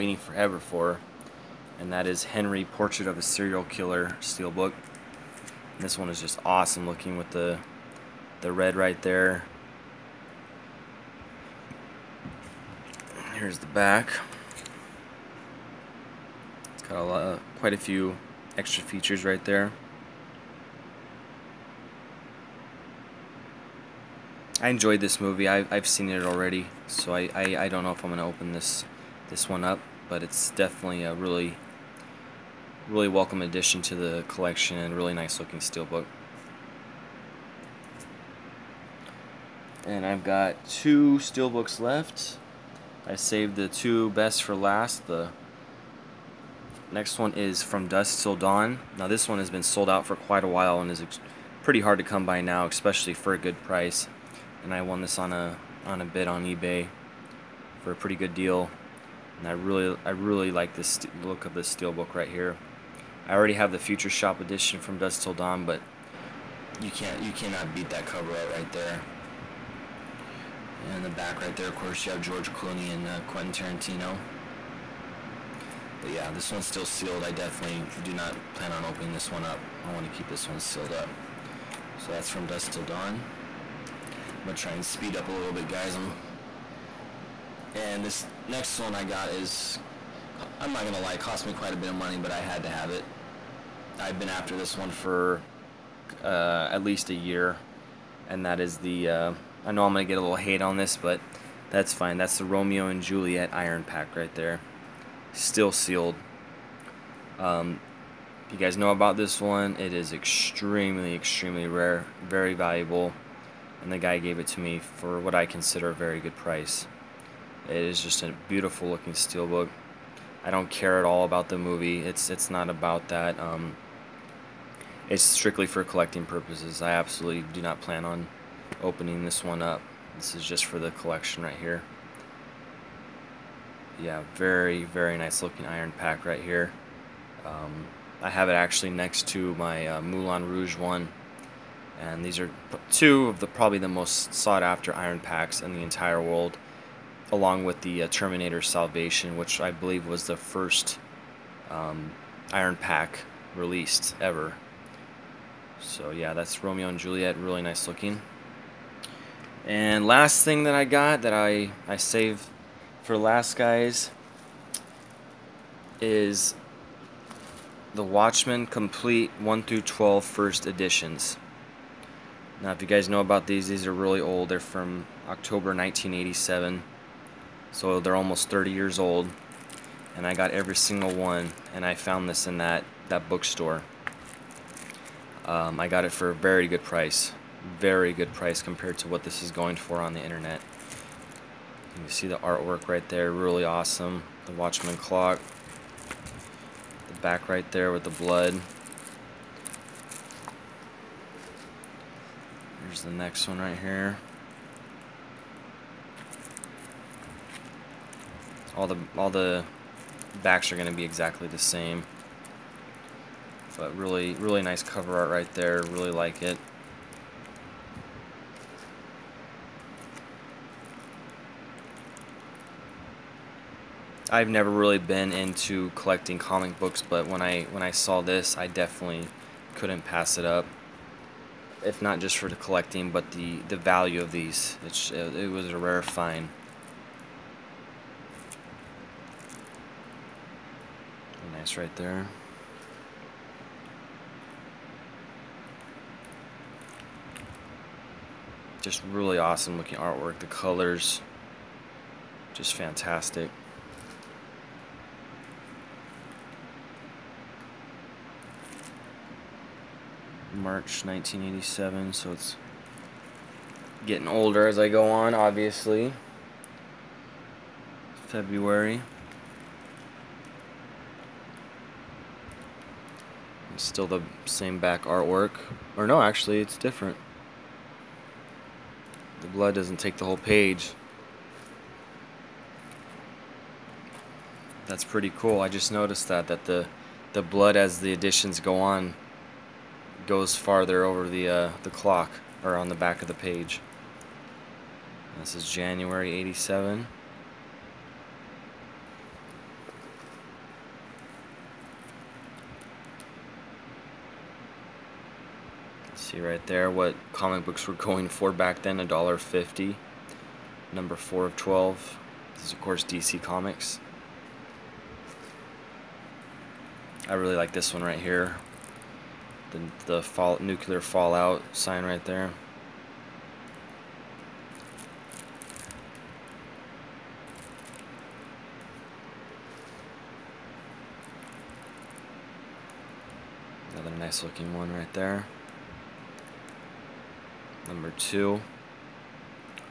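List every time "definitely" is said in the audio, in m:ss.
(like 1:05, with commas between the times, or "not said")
0:30, 1:17, 3:48.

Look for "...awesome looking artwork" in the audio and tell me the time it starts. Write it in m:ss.
4:09.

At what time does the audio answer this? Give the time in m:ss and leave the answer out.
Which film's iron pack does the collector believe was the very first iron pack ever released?
2:28.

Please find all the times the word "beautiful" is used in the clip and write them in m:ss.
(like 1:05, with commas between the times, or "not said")
1:58.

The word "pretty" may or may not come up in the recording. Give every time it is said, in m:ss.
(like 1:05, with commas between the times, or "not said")
0:51, 0:57, 4:45.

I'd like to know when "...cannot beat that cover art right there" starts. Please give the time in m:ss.
1:07.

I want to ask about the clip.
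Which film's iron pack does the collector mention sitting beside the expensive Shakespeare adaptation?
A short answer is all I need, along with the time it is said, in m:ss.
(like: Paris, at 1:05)
Moulin Rouge, at 2:20.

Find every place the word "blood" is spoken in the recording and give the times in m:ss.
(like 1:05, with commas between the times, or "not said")
3:18, 4:39, 4:47.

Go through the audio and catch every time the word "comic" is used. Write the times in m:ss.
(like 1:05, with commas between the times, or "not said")
3:46, 5:07, 5:13.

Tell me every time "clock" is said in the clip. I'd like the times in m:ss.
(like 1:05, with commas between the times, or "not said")
3:14, 4:51.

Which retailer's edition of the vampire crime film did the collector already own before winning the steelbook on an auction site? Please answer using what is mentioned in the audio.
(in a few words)
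Future Shop.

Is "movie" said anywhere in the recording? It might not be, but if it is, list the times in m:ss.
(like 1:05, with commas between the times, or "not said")
0:25, 2:01.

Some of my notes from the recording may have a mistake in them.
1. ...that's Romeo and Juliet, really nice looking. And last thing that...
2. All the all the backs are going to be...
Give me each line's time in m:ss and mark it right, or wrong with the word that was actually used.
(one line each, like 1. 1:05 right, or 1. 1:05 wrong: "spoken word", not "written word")
1. 2:36 right
2. 3:28 right.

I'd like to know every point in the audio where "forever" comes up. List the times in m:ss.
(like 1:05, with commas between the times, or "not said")
0:00.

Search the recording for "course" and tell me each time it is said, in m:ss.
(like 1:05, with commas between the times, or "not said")
1:11, 5:12.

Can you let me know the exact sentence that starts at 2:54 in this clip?
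They're from October 1987, so they're almost 30 years old.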